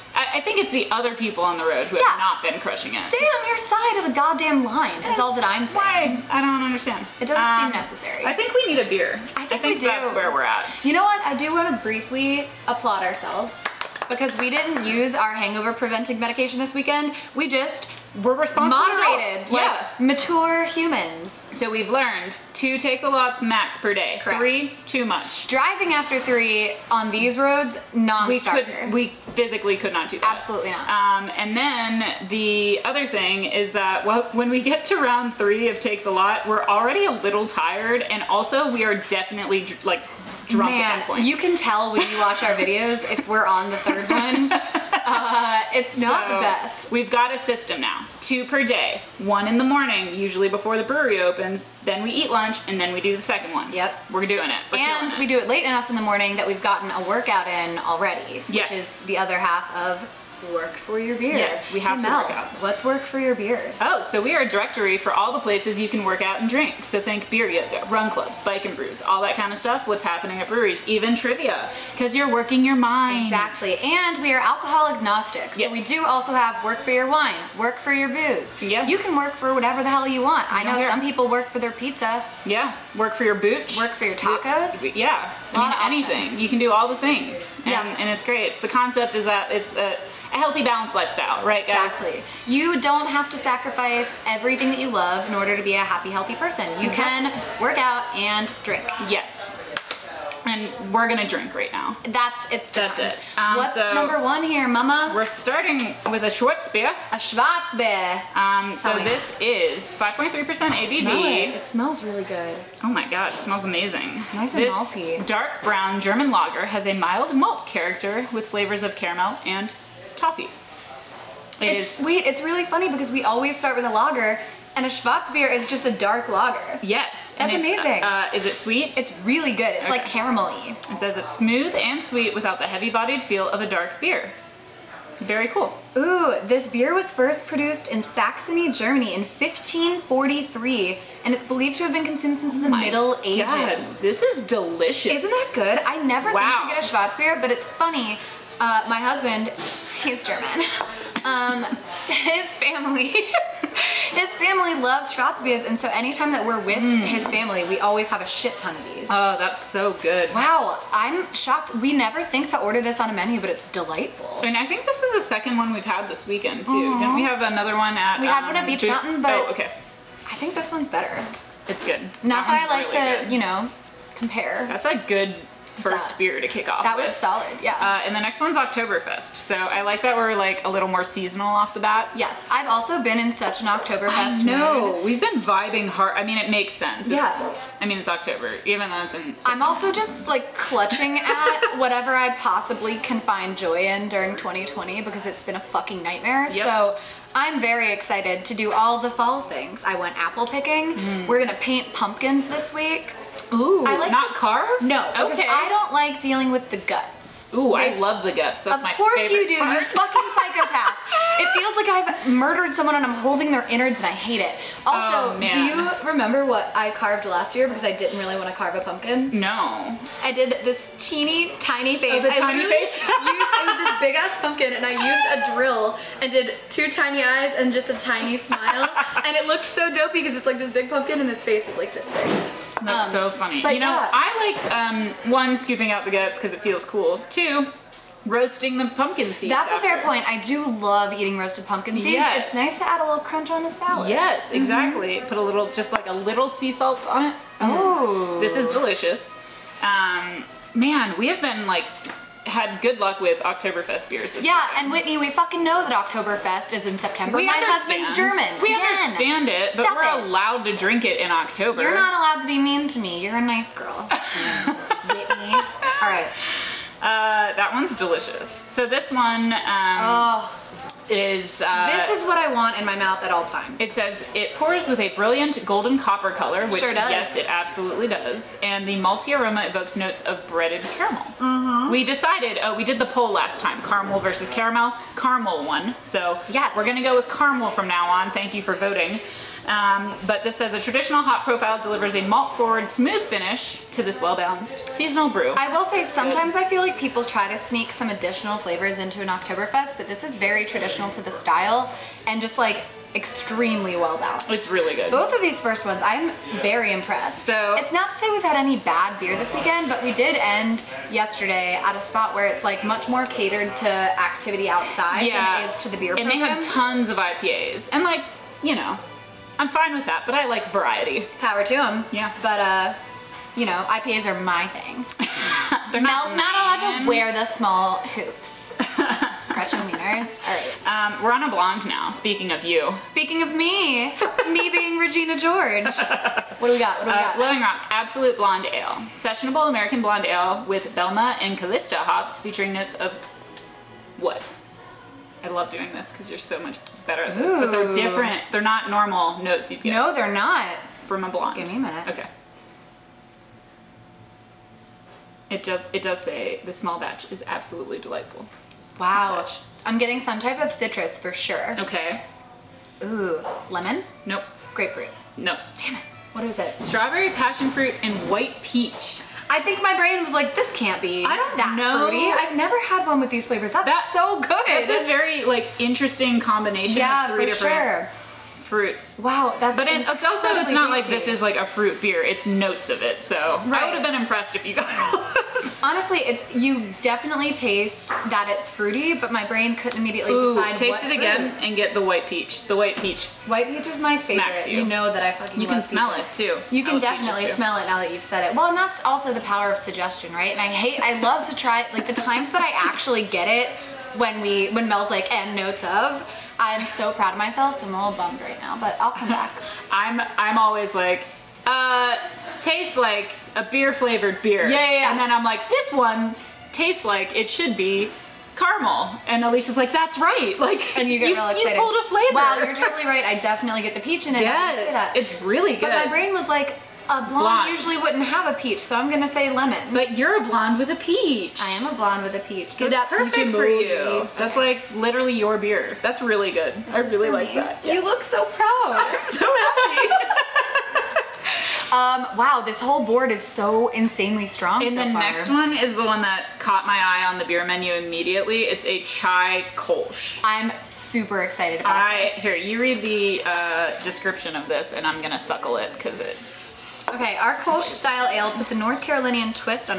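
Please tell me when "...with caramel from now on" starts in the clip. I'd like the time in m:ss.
4:47.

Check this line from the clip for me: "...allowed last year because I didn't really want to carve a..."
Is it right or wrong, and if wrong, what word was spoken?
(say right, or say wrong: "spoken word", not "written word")
wrong: "carved", not "allowed".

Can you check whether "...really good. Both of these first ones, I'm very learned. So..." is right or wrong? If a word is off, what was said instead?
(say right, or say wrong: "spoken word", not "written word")
wrong: "impressed", not "learned".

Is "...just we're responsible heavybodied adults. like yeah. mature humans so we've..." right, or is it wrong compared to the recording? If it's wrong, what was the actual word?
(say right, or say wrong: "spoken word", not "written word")
wrong: "moderated", not "heavybodied".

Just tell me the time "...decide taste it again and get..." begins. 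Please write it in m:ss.
6:30.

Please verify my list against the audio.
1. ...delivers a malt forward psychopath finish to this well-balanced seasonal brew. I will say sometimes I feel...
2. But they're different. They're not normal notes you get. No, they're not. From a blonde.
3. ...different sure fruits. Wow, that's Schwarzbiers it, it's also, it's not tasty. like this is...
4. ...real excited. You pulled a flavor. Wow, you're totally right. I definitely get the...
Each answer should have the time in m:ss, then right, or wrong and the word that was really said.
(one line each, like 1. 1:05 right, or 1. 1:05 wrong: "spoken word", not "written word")
1. 4:51 wrong: "smooth", not "psychopath"
2. 5:47 right
3. 6:17 wrong: "But", not "Schwarzbiers"
4. 7:01 right.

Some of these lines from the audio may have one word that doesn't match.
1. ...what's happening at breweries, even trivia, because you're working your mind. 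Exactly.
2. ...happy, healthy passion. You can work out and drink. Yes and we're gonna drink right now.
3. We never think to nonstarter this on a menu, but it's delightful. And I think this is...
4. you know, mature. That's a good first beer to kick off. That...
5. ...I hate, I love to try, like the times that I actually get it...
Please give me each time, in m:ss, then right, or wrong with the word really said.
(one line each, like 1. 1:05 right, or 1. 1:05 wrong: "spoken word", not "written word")
1. 1:09 right
2. 1:35 wrong: "person", not "passion"
3. 2:41 wrong: "order", not "nonstarter"
4. 2:53 wrong: "compare", not "mature"
5. 6:40 right.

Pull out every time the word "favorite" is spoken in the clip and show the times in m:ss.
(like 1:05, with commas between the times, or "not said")
3:28, 6:34.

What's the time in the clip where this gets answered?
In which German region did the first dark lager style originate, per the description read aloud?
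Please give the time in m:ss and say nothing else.
2:18.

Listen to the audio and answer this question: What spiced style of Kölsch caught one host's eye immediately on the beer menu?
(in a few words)
Chai kolsch.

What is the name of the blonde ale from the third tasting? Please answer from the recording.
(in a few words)
Blowing Rock Absolute Blonde Ale.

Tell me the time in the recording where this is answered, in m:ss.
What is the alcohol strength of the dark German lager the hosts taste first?
1:49.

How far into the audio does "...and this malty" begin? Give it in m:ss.
1:54.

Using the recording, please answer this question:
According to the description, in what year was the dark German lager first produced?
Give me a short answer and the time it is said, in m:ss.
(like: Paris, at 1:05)
1543, at 2:19.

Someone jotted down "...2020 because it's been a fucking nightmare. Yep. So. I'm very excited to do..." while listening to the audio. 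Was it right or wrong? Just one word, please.
right.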